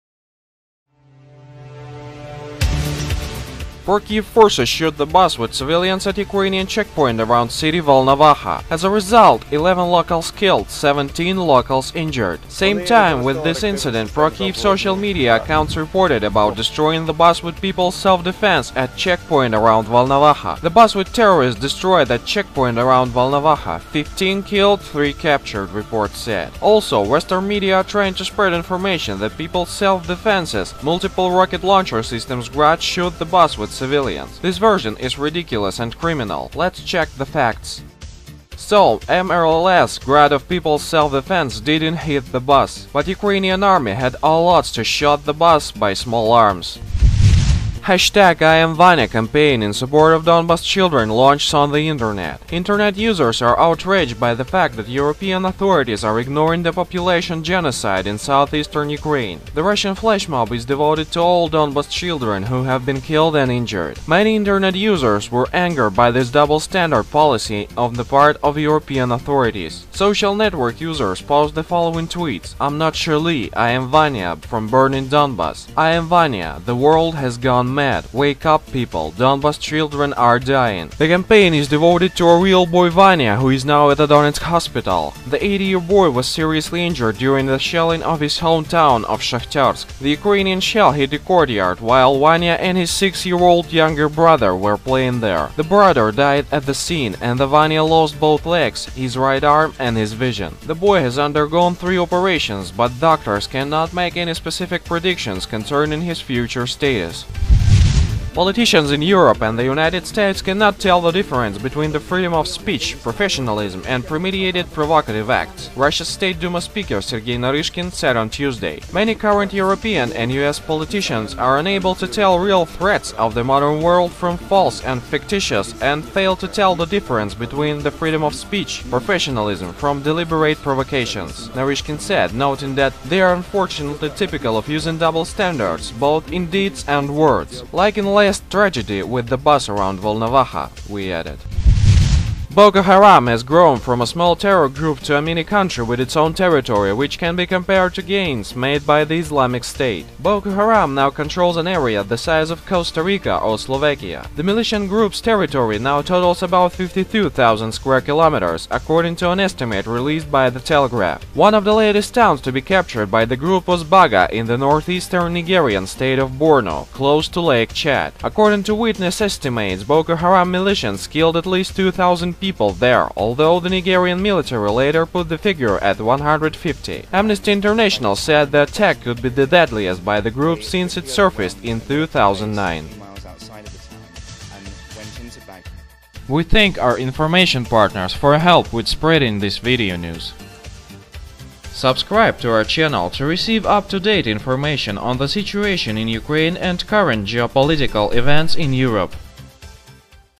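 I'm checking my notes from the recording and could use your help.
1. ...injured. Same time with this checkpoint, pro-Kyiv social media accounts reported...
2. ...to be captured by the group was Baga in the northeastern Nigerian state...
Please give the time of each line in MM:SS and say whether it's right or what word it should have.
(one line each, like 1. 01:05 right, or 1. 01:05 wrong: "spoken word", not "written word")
1. 00:11 wrong: "incident", not "checkpoint"
2. 02:42 right.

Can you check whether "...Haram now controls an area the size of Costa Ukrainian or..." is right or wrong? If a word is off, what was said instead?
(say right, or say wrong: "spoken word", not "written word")
wrong: "Rica", not "Ukrainian".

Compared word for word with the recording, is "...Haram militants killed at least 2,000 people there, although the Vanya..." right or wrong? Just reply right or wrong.
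wrong.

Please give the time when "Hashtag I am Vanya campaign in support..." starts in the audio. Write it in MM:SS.
00:47.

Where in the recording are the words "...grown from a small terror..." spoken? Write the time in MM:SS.
02:23.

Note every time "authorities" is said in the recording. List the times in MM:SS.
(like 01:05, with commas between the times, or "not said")
00:55, 01:09.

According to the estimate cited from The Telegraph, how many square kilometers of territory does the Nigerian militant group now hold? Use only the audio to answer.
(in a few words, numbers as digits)
52,000.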